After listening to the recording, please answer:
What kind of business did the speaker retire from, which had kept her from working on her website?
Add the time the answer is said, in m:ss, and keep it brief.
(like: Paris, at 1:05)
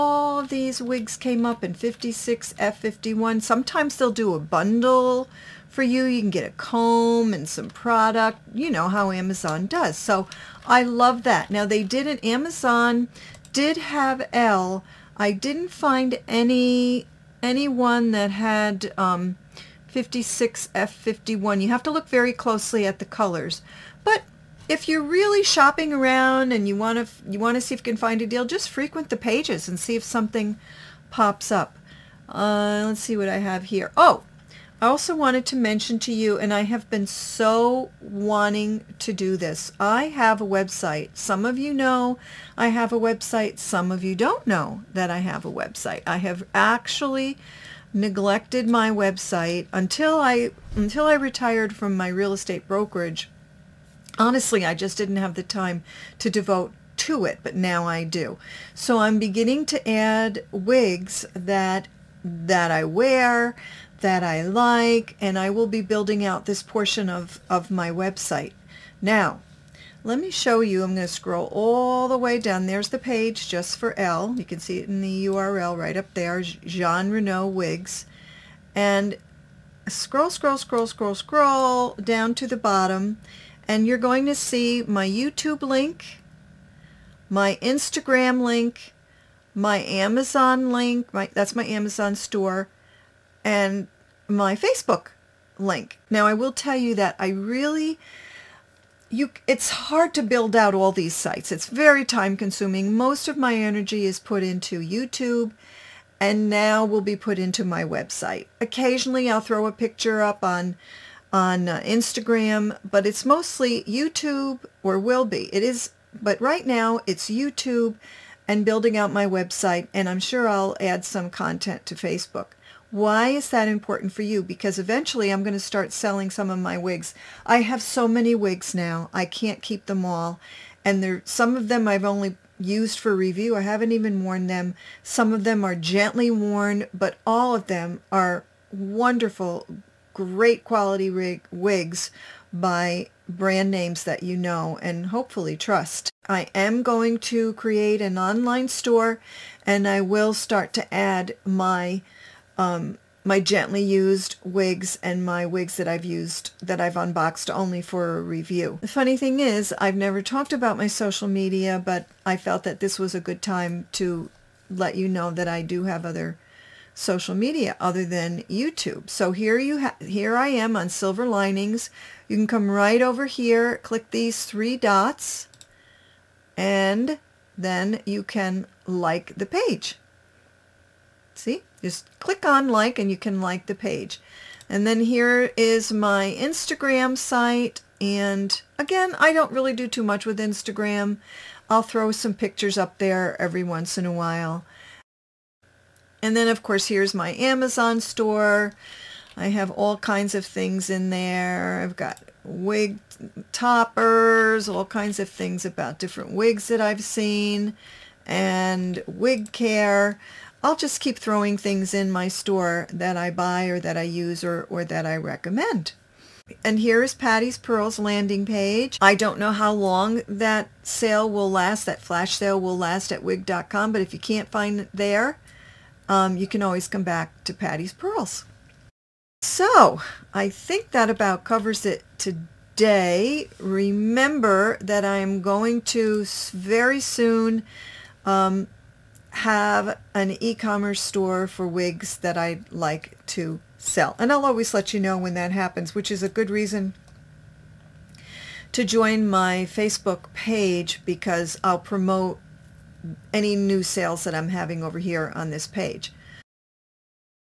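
real estate brokerage, at 0:52.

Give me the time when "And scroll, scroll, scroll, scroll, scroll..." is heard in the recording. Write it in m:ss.
1:18.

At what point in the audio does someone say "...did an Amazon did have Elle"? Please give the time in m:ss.
0:11.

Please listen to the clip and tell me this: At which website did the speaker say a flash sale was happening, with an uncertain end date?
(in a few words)
wig.com.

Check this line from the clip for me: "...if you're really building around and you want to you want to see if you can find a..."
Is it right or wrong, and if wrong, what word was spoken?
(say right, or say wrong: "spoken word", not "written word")
wrong: "shopping", not "building".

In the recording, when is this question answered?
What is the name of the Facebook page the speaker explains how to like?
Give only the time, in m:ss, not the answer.
2:50.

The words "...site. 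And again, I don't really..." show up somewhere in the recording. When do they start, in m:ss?
3:07.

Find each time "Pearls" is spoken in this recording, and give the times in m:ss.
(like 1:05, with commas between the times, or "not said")
3:37, 3:47.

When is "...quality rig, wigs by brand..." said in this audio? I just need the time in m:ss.
2:20.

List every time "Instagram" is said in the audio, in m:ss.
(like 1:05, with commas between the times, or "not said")
1:27, 1:51, 3:06, 3:10.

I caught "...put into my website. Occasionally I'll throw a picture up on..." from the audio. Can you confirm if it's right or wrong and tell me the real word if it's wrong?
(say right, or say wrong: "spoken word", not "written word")
right.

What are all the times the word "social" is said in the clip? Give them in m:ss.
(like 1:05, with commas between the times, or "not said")
2:40, 2:46.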